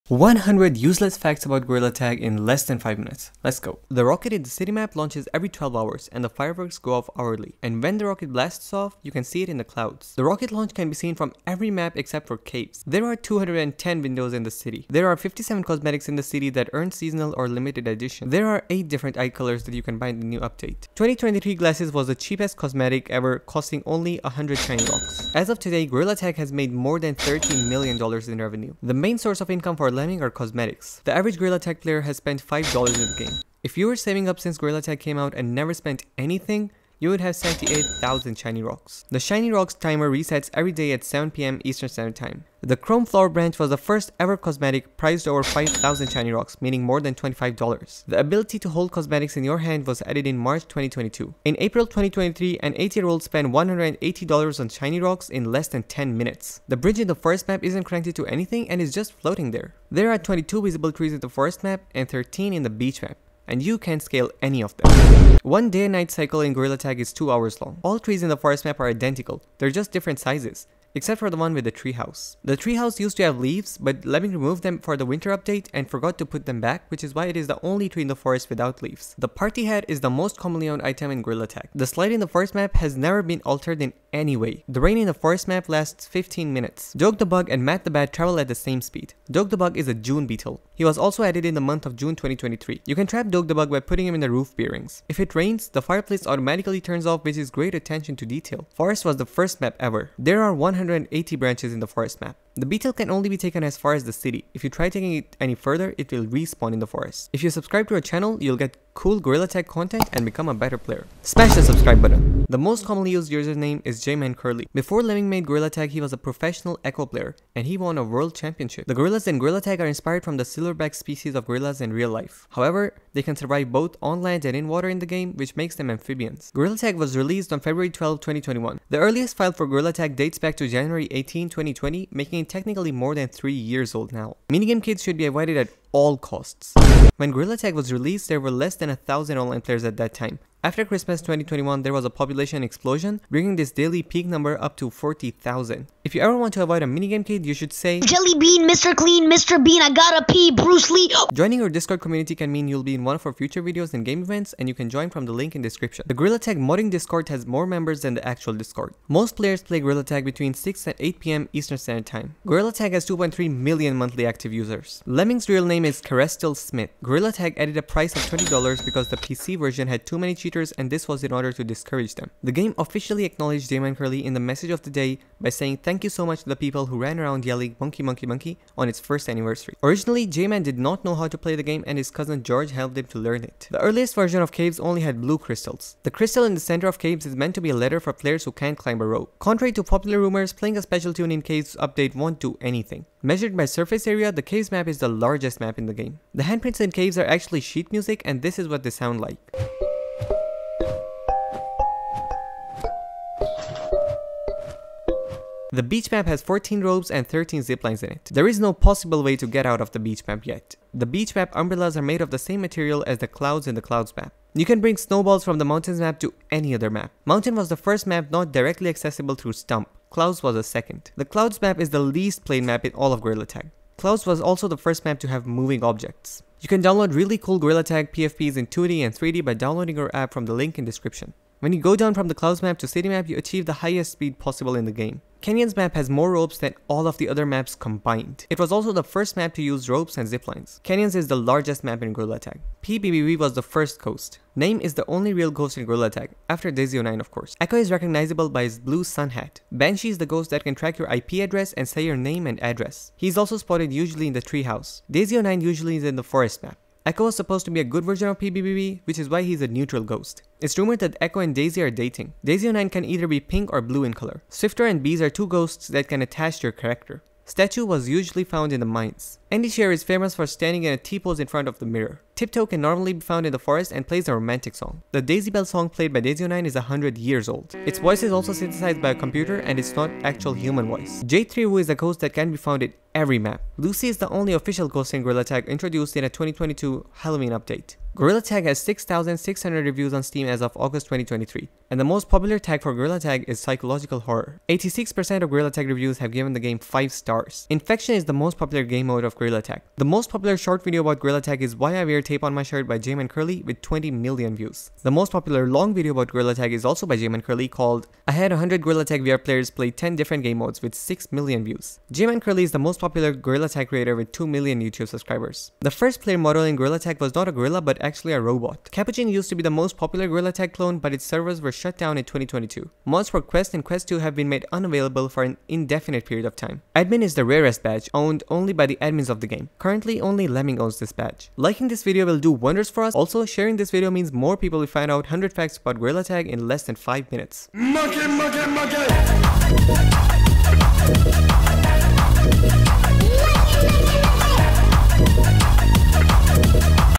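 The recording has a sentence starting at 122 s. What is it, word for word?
However, they can survive both on land and in water in the game, which makes them amphibians.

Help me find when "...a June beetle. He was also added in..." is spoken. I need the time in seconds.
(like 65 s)
89 s.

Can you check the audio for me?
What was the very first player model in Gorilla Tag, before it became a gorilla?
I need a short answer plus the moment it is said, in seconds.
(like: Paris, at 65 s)
a robot, at 318 s.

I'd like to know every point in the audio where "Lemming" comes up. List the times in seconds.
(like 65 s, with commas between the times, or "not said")
74 s, 115 s, 165 s, 330 s.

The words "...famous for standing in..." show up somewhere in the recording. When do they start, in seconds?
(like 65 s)
270 s.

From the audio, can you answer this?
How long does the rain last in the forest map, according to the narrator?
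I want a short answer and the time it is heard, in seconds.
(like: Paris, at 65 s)
15 minutes, at 86 s.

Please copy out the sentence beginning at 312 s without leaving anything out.
JManCurly is the most popular Gorilla Tag creator with 2 million YouTube subscribers.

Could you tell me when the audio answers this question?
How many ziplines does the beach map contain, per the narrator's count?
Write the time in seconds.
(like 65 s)
207 s.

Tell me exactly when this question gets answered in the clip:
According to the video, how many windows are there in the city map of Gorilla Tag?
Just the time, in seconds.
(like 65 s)
13 s.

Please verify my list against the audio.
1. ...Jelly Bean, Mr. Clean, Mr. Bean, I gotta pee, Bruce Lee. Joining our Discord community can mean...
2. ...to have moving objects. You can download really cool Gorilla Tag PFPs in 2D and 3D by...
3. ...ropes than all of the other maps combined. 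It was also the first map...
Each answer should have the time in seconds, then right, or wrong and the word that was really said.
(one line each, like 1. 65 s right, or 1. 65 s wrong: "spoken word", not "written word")
1. 147 s right
2. 225 s right
3. 236 s right.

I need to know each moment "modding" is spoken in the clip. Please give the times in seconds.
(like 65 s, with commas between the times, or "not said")
156 s.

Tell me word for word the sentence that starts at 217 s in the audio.
Mountain was the first map not directly accessible through Stump.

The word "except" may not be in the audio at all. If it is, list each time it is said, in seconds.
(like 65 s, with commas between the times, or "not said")
11 s, 70 s.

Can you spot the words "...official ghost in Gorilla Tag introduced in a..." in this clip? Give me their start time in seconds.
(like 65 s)
284 s.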